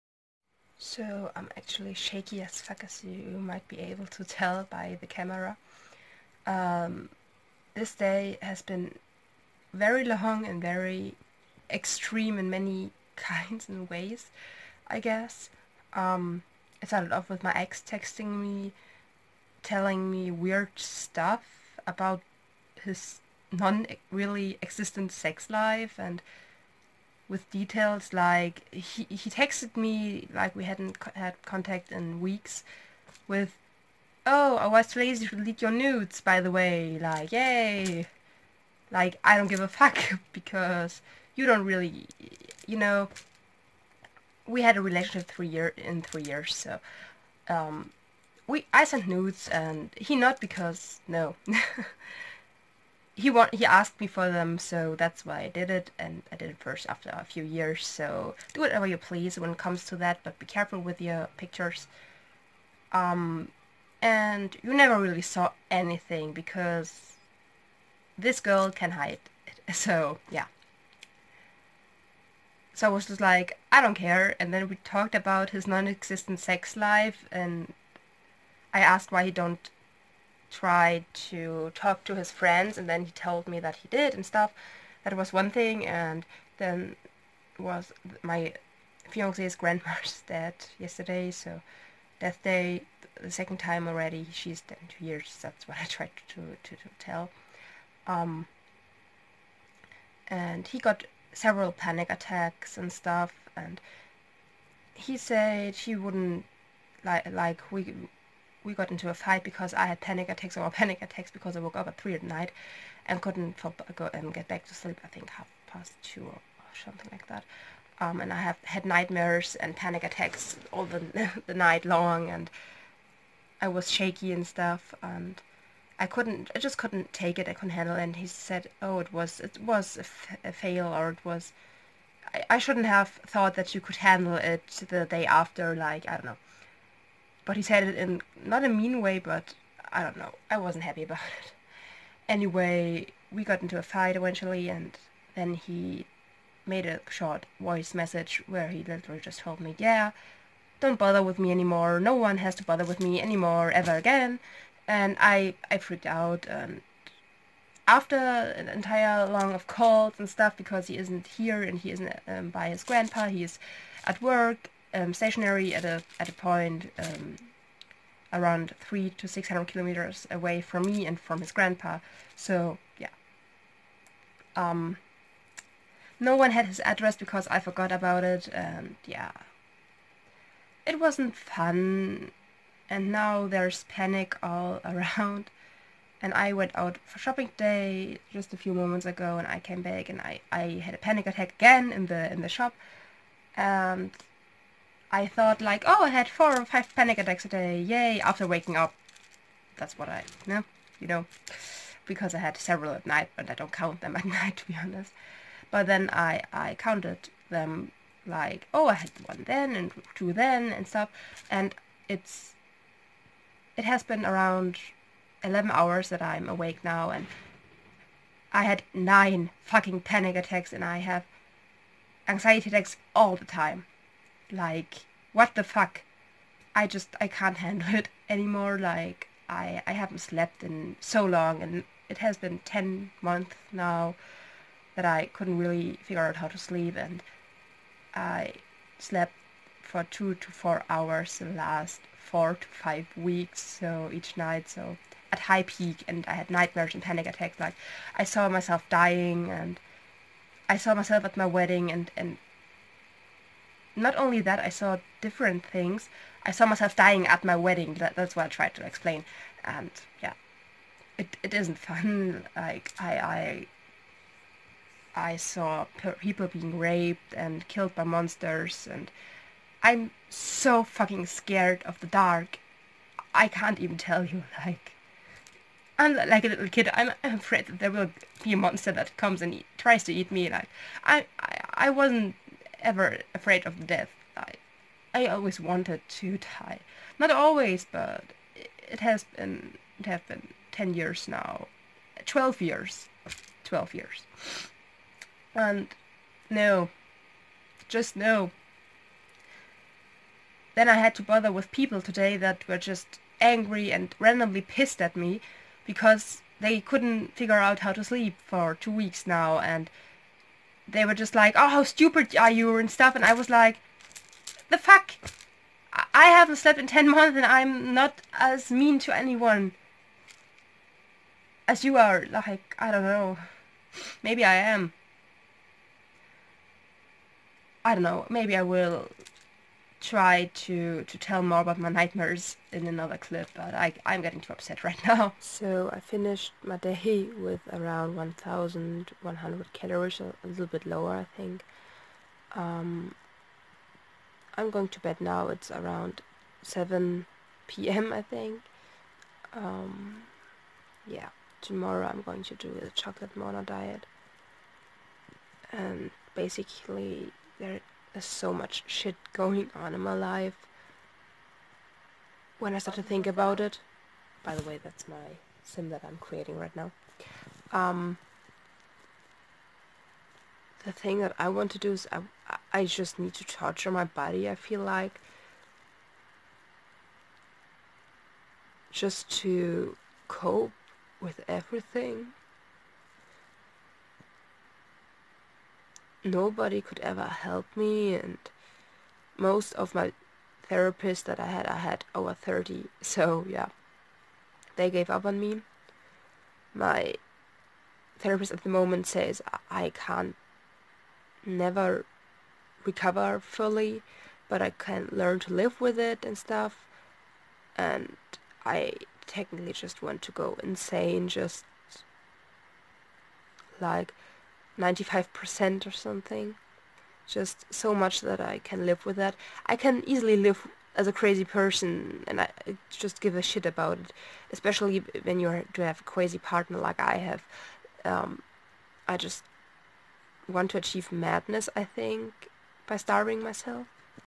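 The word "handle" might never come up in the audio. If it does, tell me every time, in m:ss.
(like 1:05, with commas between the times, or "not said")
2:07, 2:13, 3:47.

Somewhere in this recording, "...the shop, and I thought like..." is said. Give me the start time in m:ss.
3:12.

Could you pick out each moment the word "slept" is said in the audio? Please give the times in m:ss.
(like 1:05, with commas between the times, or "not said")
3:50, 3:58, 5:16.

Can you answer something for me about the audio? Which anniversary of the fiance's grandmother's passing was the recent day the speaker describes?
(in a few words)
the second.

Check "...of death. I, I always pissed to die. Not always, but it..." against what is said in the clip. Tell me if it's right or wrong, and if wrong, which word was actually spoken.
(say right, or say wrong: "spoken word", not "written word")
wrong: "wanted", not "pissed".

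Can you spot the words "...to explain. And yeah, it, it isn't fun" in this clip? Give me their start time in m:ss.
4:18.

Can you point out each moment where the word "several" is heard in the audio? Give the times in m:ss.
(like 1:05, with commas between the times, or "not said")
1:41, 3:22.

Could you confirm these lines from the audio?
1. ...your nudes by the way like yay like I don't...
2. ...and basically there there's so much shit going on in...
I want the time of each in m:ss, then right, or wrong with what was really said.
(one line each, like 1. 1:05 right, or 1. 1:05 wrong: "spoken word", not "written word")
1. 0:35 right
2. 5:55 right.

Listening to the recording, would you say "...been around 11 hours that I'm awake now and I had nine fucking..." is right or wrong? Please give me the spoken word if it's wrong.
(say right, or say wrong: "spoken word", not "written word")
right.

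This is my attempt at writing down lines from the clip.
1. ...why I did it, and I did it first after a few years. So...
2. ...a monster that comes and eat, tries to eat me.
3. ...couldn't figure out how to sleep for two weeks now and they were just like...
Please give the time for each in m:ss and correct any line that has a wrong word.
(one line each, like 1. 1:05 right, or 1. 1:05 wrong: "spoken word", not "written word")
1. 0:55 right
2. 4:38 right
3. 5:06 right.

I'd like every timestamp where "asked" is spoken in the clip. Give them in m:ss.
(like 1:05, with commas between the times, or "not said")
0:53, 1:18.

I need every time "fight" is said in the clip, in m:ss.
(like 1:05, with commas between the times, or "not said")
1:49, 2:23.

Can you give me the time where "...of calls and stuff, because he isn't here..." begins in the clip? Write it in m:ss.
2:39.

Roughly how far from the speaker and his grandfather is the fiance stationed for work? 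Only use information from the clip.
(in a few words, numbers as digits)
300 to 600 kilometers.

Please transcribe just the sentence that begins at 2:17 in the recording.
But he said it in not a mean way, but I don't know.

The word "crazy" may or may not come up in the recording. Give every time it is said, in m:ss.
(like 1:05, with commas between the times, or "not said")
7:01, 7:06.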